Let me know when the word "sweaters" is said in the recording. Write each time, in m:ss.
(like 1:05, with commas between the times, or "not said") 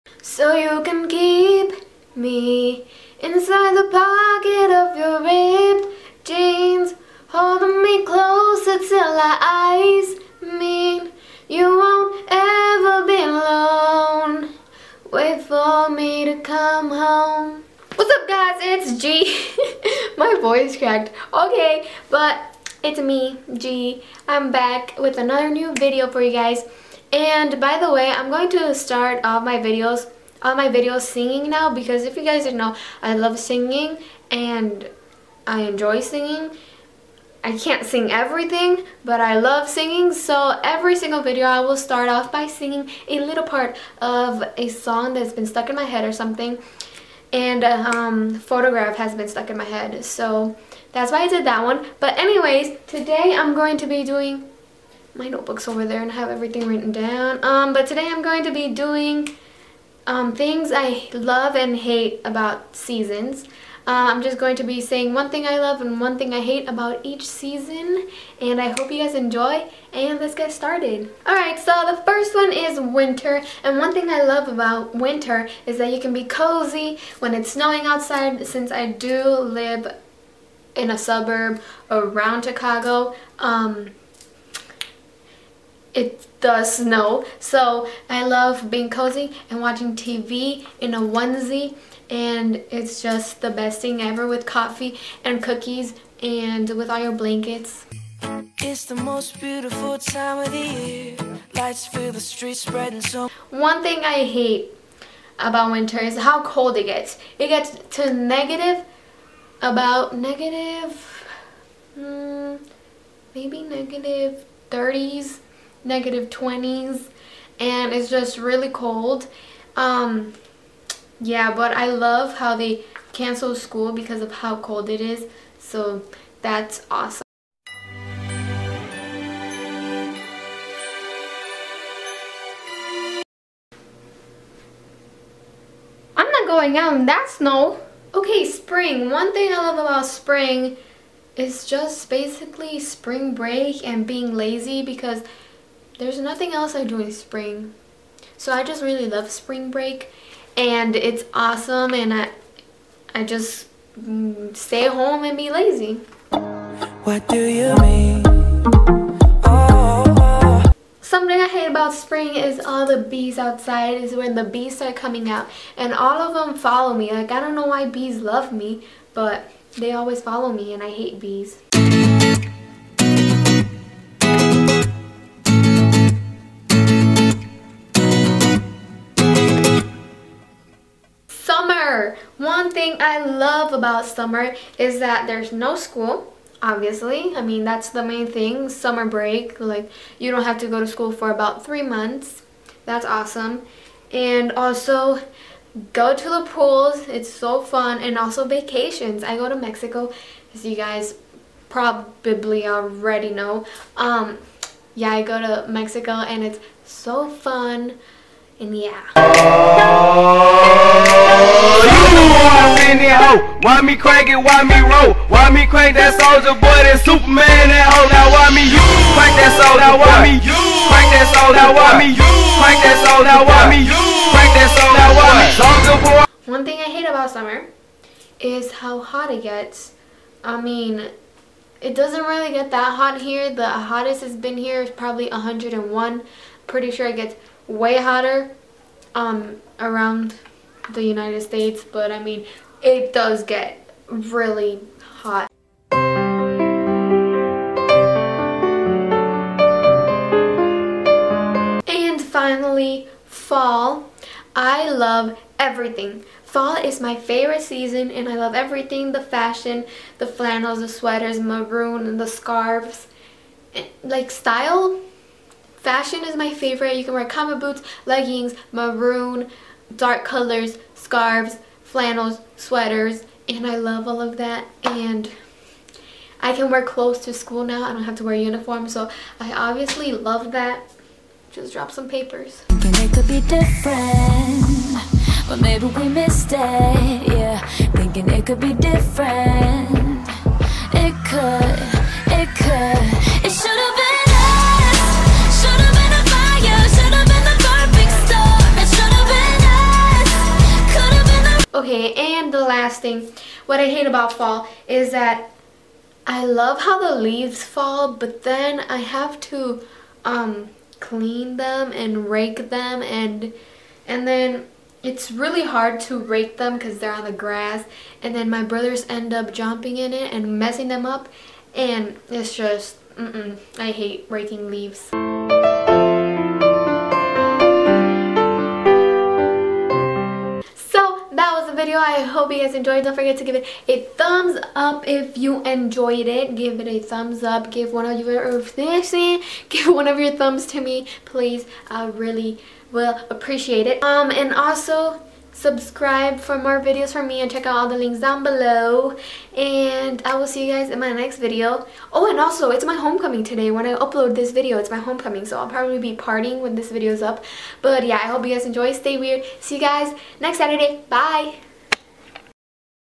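4:20, 4:32.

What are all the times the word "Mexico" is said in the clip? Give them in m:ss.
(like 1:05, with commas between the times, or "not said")
3:19, 3:25.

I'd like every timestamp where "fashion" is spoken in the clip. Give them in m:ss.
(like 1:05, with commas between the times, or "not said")
4:19, 4:25.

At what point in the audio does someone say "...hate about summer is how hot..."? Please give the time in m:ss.
3:46.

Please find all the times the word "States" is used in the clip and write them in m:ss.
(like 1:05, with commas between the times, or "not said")
4:01.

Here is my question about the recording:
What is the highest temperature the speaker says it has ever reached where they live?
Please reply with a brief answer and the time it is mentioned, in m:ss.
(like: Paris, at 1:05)
101, at 3:55.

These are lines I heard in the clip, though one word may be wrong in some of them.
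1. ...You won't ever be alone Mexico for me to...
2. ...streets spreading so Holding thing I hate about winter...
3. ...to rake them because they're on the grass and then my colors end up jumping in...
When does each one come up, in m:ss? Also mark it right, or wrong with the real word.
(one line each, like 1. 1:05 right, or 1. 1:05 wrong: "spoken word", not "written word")
1. 0:11 wrong: "Wait", not "Mexico"
2. 1:42 wrong: "One", not "Holding"
3. 5:16 wrong: "brothers", not "colors".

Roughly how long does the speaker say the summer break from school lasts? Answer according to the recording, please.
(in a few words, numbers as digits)
About three months.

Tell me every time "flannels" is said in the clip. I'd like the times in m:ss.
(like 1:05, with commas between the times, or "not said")
4:20, 4:31.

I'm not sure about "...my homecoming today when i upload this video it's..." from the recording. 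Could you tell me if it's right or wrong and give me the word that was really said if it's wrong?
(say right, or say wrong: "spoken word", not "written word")
right.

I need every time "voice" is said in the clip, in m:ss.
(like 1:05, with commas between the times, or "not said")
0:20.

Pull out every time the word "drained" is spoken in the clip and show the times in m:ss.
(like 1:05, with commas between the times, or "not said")
not said.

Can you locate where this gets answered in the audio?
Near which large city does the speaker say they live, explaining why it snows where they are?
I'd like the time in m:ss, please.
1:22.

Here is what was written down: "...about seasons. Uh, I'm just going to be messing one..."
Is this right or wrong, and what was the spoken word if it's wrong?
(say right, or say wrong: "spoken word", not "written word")
wrong: "saying", not "messing".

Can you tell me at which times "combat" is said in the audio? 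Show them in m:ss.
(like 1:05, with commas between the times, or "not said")
4:27.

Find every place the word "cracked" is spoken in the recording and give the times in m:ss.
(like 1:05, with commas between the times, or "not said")
0:20.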